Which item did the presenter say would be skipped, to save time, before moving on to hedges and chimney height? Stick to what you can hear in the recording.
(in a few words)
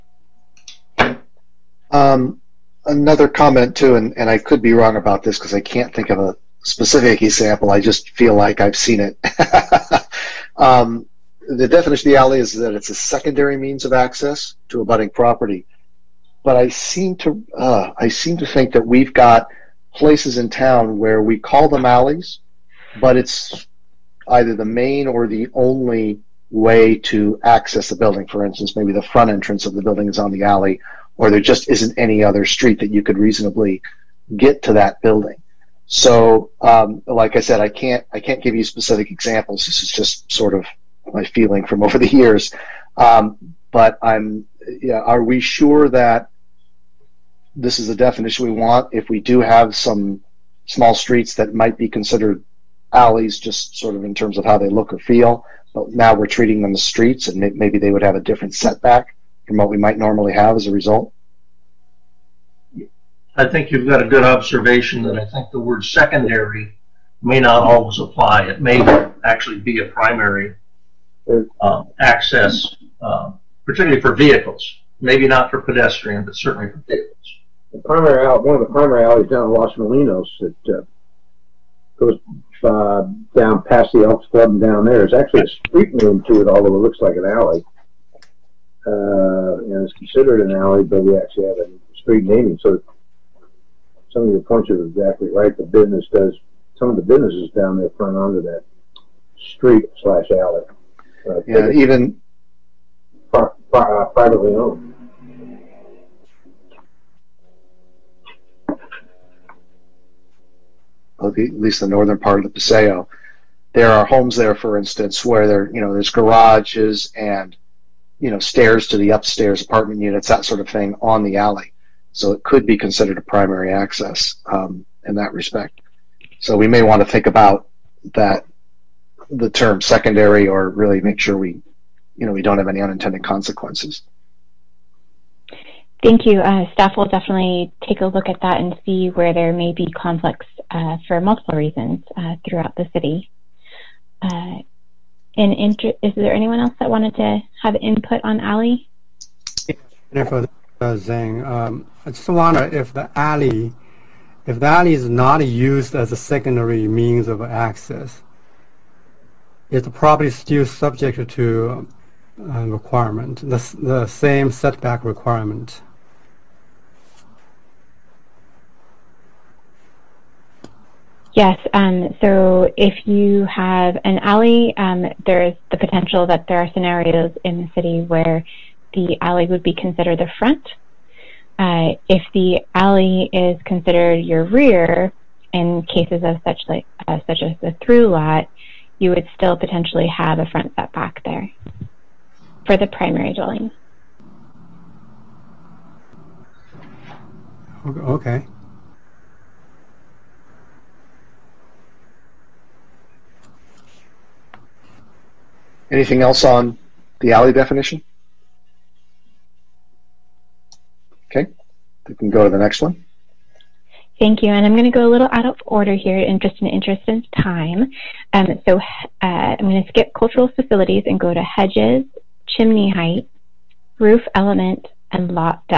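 Cultural facilities.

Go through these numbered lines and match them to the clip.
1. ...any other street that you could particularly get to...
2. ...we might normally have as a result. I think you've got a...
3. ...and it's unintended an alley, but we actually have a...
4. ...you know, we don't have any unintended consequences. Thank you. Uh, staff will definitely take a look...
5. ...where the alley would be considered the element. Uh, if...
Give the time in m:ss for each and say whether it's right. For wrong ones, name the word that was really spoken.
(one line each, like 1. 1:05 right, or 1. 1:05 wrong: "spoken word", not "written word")
1. 0:31 wrong: "reasonably", not "particularly"
2. 0:59 right
3. 1:29 wrong: "considered", not "unintended"
4. 2:12 right
5. 2:58 wrong: "front", not "element".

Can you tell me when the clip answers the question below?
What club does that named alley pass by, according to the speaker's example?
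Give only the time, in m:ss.
1:24.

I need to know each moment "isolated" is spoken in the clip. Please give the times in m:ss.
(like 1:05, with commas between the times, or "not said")
not said.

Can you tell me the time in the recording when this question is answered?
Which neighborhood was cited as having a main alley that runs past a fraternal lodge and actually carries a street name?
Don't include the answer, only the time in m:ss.
1:19.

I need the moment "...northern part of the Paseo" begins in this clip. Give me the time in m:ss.
1:51.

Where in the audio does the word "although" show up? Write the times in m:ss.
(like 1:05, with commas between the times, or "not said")
1:26.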